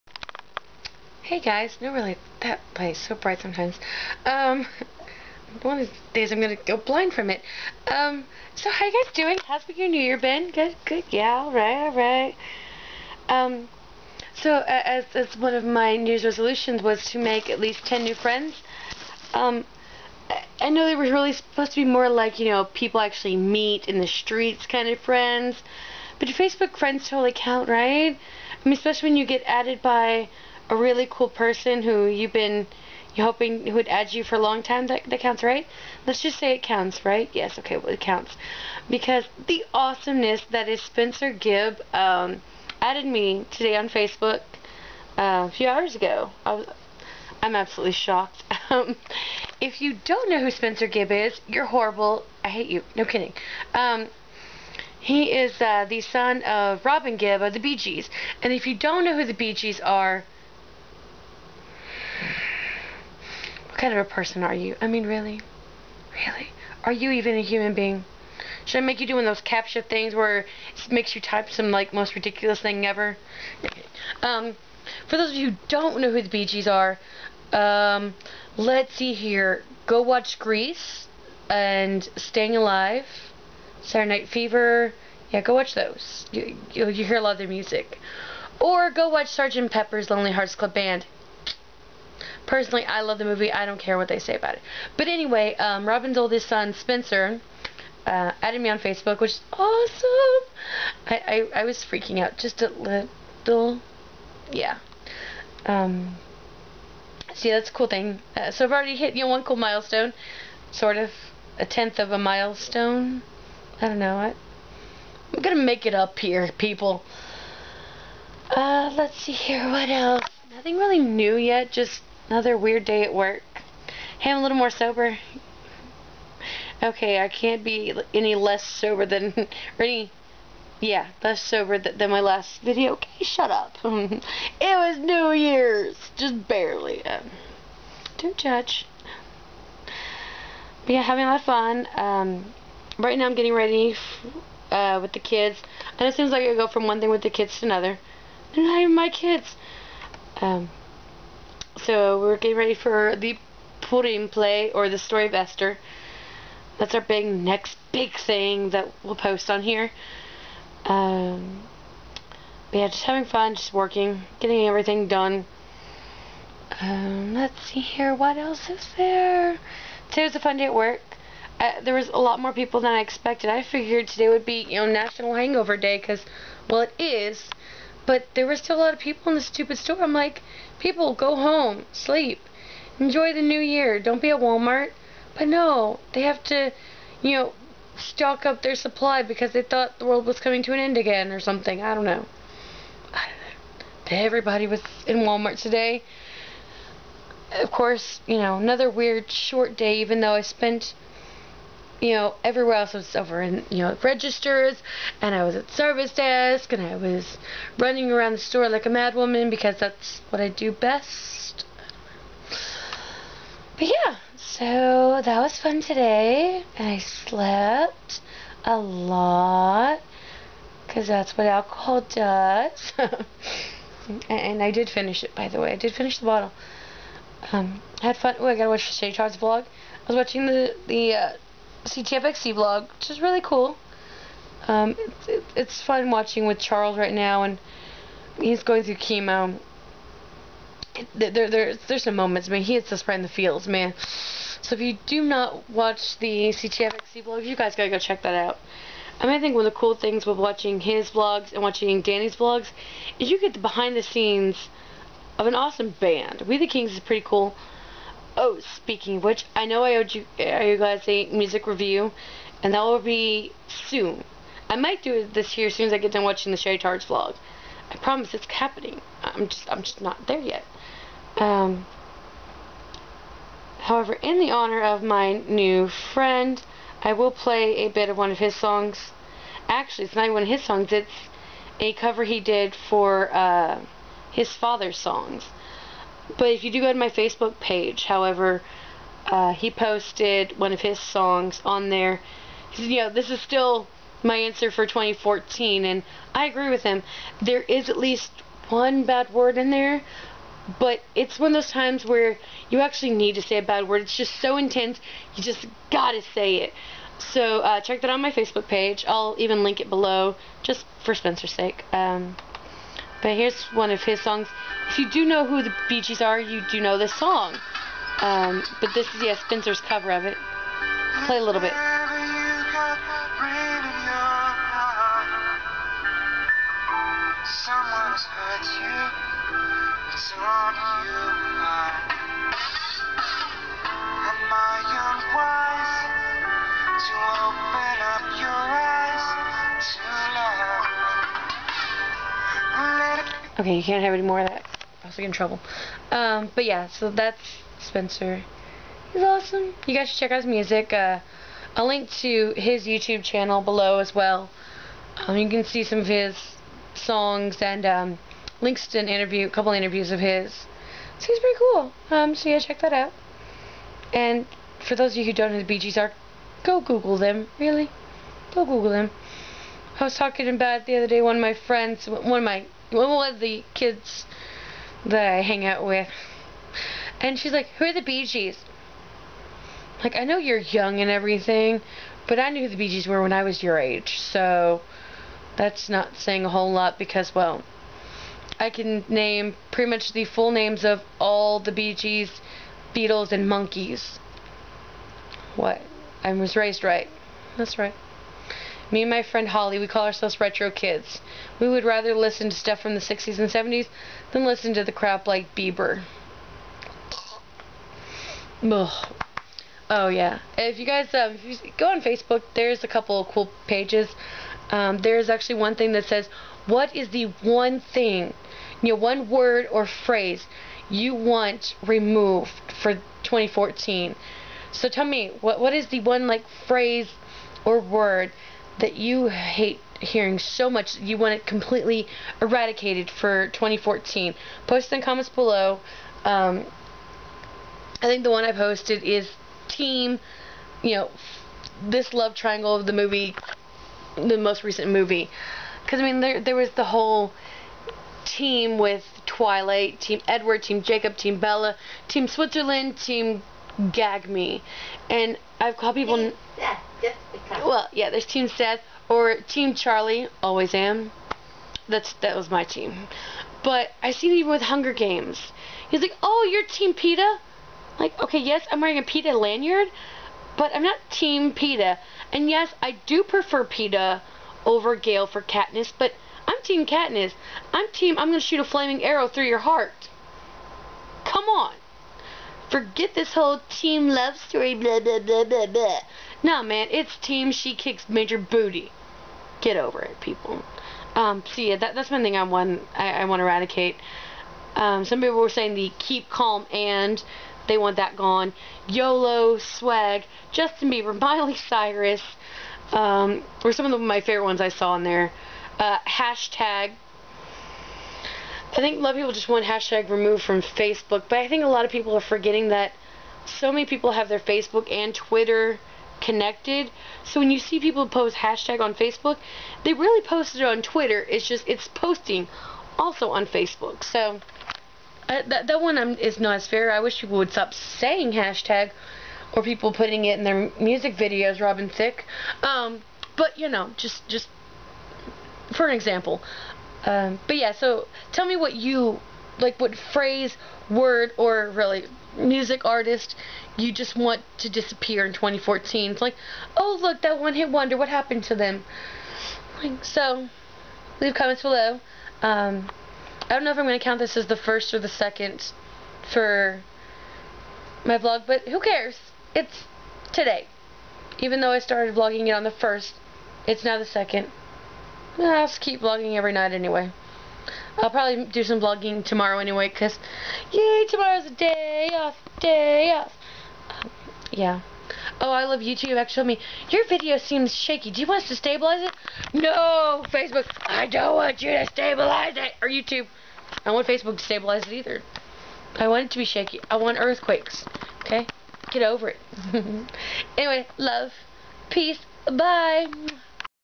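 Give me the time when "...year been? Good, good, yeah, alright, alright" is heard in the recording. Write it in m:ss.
0:10.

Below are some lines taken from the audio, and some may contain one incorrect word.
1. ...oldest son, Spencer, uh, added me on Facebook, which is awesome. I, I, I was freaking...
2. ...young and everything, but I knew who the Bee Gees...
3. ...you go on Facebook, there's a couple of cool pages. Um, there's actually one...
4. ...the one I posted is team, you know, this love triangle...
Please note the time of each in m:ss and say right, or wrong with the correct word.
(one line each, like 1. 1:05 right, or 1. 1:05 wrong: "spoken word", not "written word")
1. 1:36 right
2. 6:20 right
3. 6:51 right
4. 7:18 right.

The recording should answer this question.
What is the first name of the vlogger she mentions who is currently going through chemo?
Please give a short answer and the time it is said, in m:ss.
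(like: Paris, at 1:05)
Charles, at 3:56.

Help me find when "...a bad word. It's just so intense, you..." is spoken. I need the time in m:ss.
5:03.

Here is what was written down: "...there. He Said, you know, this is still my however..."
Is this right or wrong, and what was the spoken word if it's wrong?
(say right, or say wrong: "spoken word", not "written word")
wrong: "answer", not "however".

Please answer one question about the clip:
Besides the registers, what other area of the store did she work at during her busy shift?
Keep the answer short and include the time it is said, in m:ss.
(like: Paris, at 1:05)
Service desk, at 3:25.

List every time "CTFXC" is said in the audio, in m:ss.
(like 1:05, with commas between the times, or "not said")
3:51, 4:06.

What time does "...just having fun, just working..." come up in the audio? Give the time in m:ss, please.
2:42.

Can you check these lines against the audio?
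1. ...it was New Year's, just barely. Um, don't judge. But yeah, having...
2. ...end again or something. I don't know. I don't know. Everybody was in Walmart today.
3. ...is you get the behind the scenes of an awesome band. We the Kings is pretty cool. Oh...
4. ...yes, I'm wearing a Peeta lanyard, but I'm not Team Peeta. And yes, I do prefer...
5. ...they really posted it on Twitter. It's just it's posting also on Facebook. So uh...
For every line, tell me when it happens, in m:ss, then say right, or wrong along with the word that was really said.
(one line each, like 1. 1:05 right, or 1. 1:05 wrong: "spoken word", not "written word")
1. 2:14 right
2. 3:10 right
3. 4:13 right
4. 7:48 right
5. 8:39 right.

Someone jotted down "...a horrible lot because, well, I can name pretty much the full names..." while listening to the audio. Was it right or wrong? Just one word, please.
wrong.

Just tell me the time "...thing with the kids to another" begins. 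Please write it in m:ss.
2:27.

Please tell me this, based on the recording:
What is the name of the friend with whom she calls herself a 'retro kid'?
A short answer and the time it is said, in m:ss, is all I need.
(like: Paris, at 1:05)
Holly, at 6:39.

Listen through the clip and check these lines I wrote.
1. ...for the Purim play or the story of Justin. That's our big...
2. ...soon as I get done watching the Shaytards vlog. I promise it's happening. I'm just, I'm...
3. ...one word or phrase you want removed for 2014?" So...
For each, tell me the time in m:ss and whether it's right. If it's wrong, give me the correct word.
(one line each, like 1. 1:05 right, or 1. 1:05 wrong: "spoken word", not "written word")
1. 2:32 wrong: "Esther", not "Justin"
2. 4:25 right
3. 6:58 right.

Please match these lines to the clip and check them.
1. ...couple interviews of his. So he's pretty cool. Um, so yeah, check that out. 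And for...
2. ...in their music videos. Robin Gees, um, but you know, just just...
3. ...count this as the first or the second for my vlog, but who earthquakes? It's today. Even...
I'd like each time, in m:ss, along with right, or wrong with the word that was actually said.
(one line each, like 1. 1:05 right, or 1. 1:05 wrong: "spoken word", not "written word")
1. 5:59 right
2. 8:50 wrong: "Thicke", not "Gees"
3. 9:13 wrong: "cares", not "earthquakes".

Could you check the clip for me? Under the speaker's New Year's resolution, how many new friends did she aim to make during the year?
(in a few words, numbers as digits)
10.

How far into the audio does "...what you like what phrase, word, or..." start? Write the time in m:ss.
8:58.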